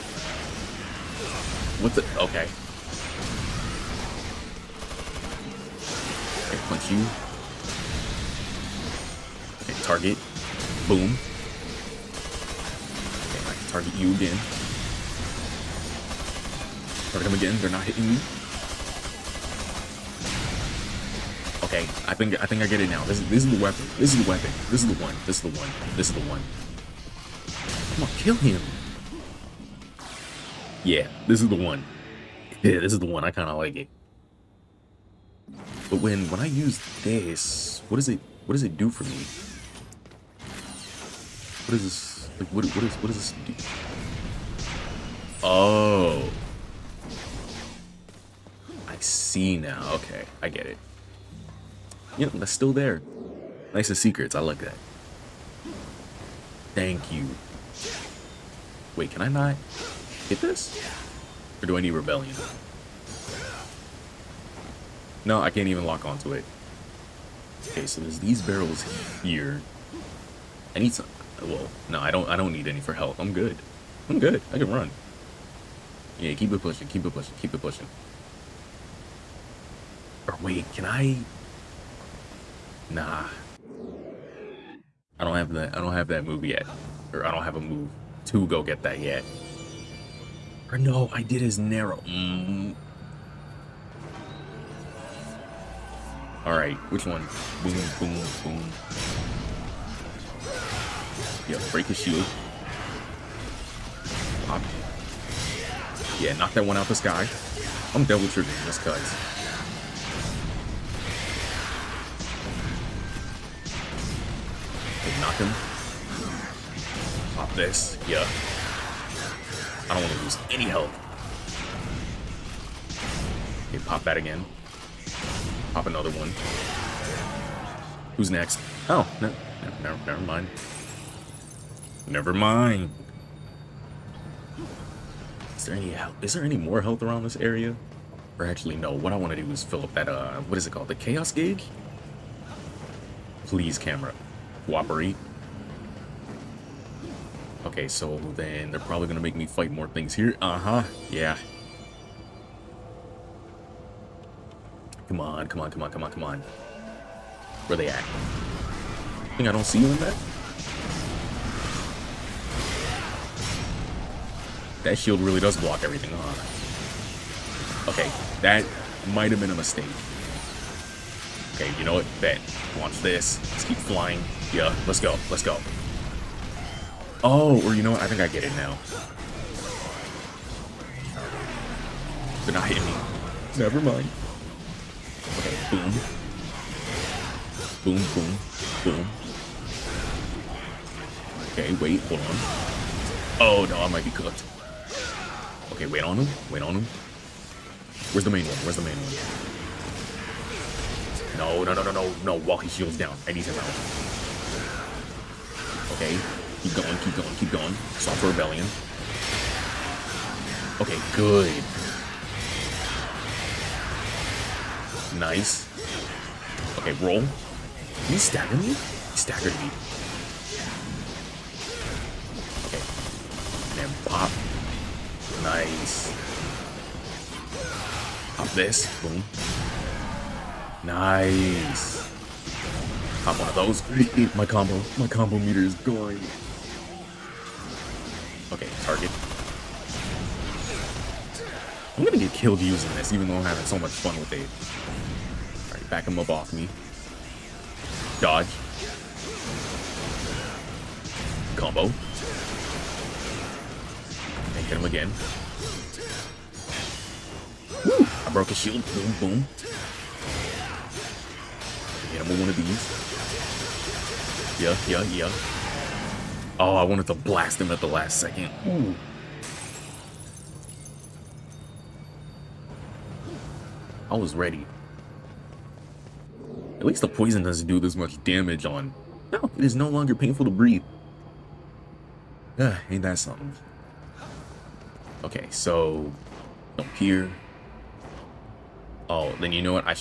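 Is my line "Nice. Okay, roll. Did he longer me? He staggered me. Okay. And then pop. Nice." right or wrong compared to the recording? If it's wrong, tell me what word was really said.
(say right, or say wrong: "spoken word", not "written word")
wrong: "stagger", not "longer".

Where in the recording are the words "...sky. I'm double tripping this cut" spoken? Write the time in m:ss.
1:46.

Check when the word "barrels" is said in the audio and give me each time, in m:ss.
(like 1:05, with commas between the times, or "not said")
1:08.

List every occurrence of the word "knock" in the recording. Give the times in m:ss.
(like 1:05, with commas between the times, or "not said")
1:46, 1:55.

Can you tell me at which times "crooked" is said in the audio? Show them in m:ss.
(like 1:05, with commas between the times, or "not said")
not said.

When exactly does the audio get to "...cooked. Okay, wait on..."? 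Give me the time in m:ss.
3:14.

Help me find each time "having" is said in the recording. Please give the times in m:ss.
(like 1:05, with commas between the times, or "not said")
4:03.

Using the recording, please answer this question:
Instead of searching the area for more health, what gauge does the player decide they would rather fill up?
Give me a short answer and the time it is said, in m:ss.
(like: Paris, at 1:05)
chaos gig, at 2:20.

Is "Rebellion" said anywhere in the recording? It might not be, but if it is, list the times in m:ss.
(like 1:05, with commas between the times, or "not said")
1:01, 3:28.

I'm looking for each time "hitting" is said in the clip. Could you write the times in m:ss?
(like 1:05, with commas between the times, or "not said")
0:17, 3:02.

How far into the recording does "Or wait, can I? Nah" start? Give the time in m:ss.
1:20.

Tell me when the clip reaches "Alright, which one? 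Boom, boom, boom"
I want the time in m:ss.
1:36.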